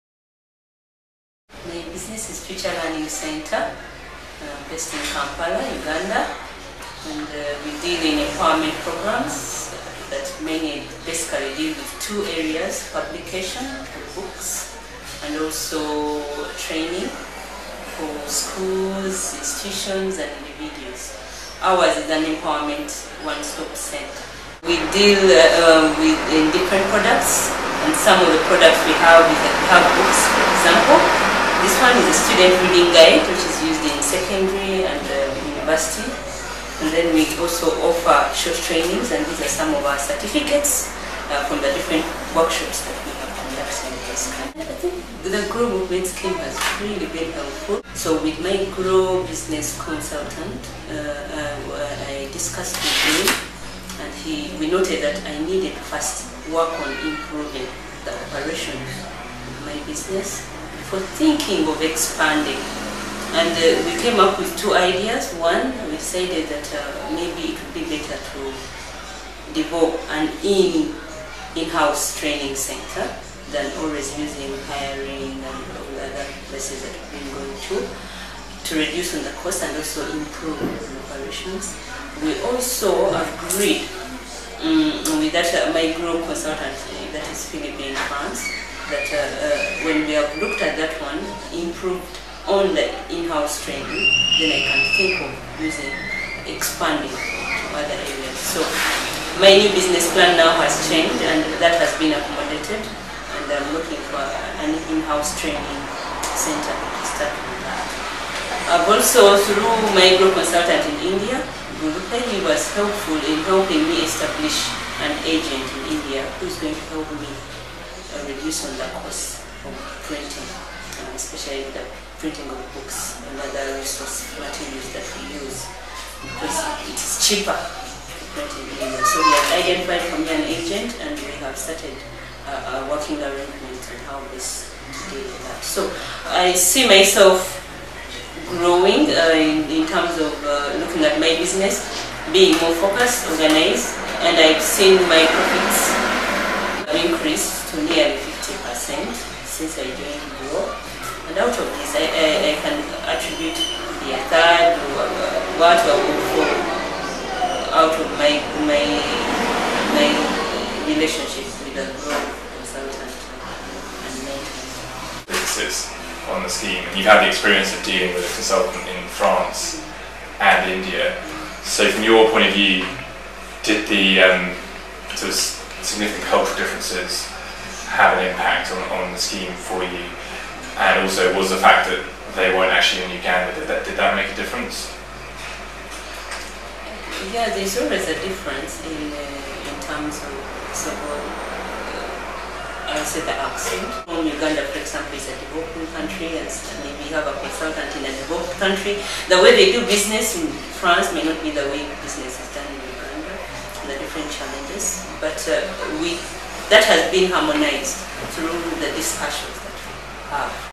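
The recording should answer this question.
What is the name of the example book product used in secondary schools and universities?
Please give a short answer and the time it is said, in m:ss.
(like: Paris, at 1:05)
Student reading guide, at 0:32.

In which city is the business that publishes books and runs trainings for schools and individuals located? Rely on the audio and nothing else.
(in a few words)
Kampala.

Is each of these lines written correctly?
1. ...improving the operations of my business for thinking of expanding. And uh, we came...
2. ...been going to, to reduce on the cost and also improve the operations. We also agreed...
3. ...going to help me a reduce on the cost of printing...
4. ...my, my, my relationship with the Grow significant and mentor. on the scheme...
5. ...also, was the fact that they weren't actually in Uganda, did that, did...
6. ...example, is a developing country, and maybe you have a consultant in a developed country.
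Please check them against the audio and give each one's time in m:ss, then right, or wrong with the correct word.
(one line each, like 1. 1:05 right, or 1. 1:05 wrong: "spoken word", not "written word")
1. 0:57 right
2. 1:17 right
3. 1:56 right
4. 2:38 wrong: "consultant", not "significant"
5. 3:01 right
6. 3:14 right.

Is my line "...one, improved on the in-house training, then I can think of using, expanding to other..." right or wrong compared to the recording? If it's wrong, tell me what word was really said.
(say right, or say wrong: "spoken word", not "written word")
right.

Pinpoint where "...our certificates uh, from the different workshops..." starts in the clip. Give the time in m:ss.
0:39.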